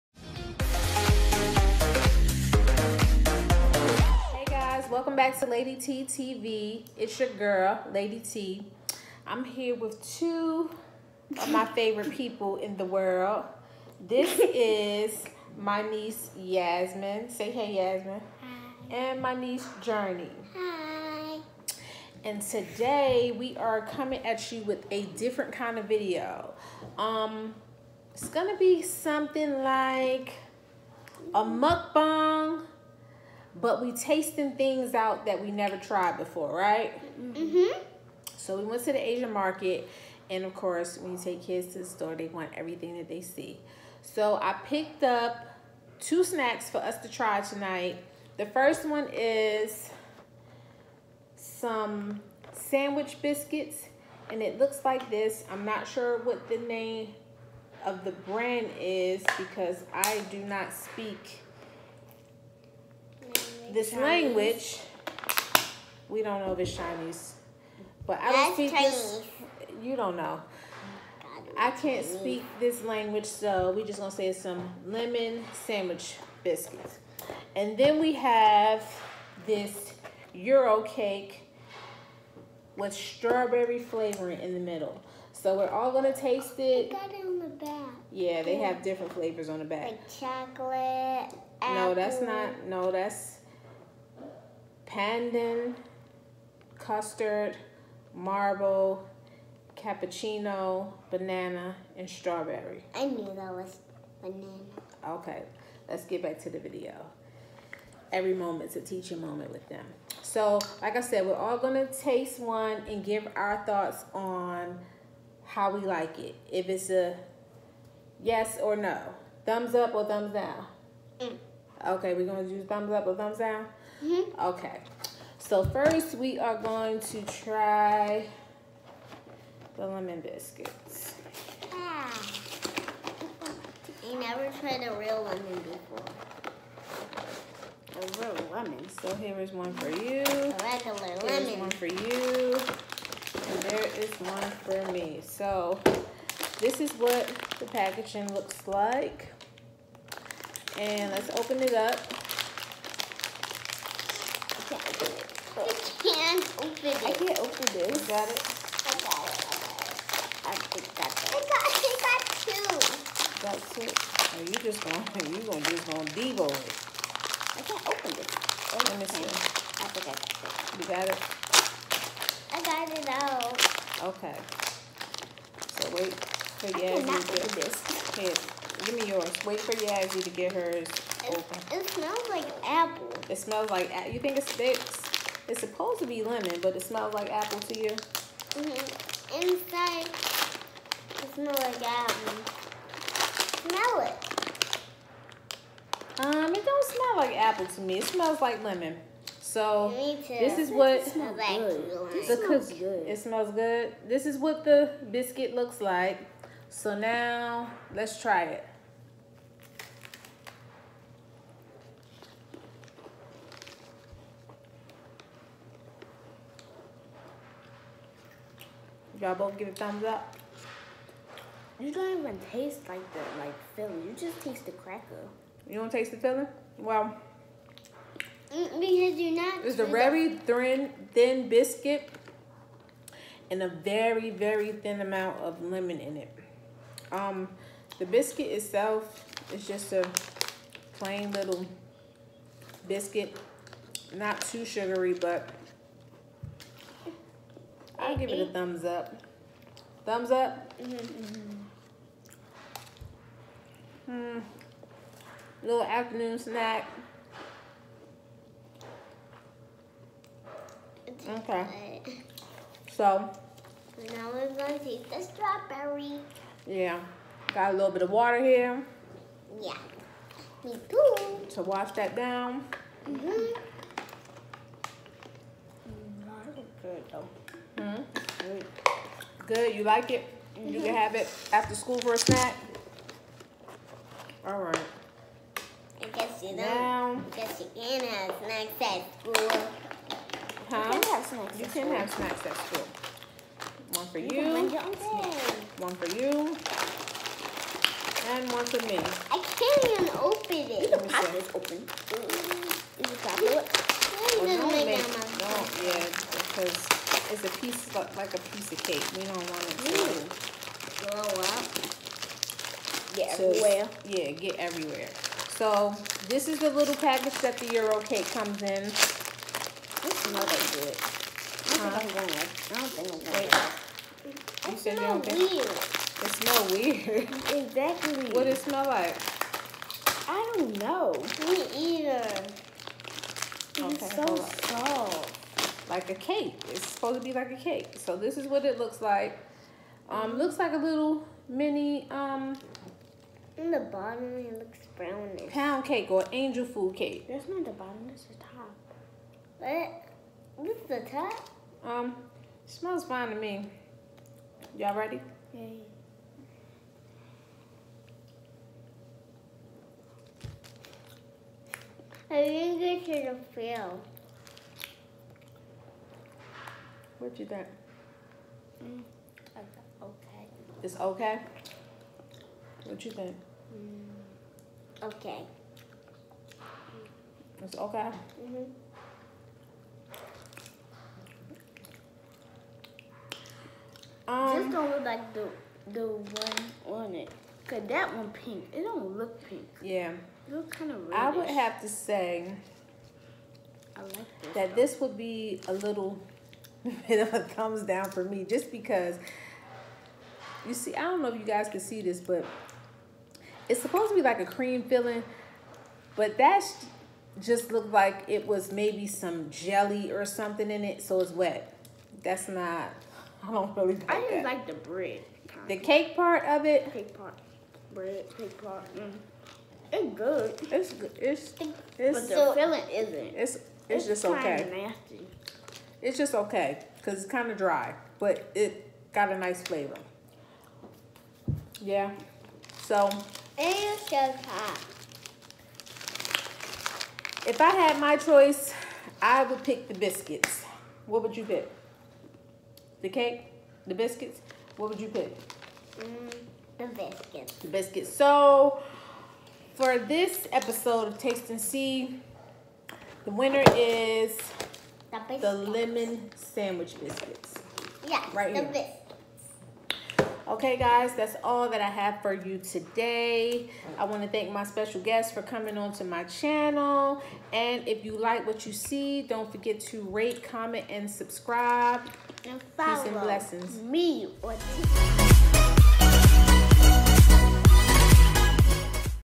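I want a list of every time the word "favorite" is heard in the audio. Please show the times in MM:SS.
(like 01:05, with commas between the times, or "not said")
00:11.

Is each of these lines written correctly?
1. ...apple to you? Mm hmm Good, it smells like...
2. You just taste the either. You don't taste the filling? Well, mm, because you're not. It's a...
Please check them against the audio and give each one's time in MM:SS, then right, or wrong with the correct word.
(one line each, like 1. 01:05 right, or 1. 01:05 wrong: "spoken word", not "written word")
1. 03:07 wrong: "Inside", not "Good"
2. 03:44 wrong: "cracker", not "either".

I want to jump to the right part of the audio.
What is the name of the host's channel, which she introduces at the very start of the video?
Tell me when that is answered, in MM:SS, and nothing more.
00:05.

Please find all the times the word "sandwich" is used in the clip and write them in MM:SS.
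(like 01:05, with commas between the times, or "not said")
00:52, 01:15, 07:36.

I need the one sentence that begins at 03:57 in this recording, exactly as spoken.
Um, the biscuit itself is just a plain little biscuit, not too sugary, but I'll give eight.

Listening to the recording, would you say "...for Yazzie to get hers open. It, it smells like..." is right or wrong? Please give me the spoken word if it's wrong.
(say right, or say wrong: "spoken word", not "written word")
right.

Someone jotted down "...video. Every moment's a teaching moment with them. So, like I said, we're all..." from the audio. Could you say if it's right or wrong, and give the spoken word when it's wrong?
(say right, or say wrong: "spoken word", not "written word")
right.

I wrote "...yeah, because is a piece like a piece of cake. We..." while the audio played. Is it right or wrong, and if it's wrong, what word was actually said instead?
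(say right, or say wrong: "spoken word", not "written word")
right.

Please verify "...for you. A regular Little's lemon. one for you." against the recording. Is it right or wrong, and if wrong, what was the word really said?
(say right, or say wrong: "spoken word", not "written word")
wrong: "Here", not "Little".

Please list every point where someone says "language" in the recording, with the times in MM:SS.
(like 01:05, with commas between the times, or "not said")
01:04, 01:12.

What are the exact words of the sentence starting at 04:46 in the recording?
Now, I guess you can have snacks at school.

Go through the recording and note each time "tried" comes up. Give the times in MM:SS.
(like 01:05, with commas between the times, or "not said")
00:35, 02:14.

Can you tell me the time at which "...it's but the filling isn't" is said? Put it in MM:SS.
07:01.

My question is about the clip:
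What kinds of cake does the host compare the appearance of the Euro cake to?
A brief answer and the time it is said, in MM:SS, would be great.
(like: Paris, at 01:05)
Pound cake or angel food cake, at 05:45.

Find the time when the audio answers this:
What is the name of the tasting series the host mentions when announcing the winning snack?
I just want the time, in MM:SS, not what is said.
07:31.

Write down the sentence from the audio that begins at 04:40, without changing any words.
can have it after school for a snack.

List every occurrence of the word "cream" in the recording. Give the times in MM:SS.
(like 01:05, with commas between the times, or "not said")
06:44.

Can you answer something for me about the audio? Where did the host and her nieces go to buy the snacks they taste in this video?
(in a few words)
The Asian market.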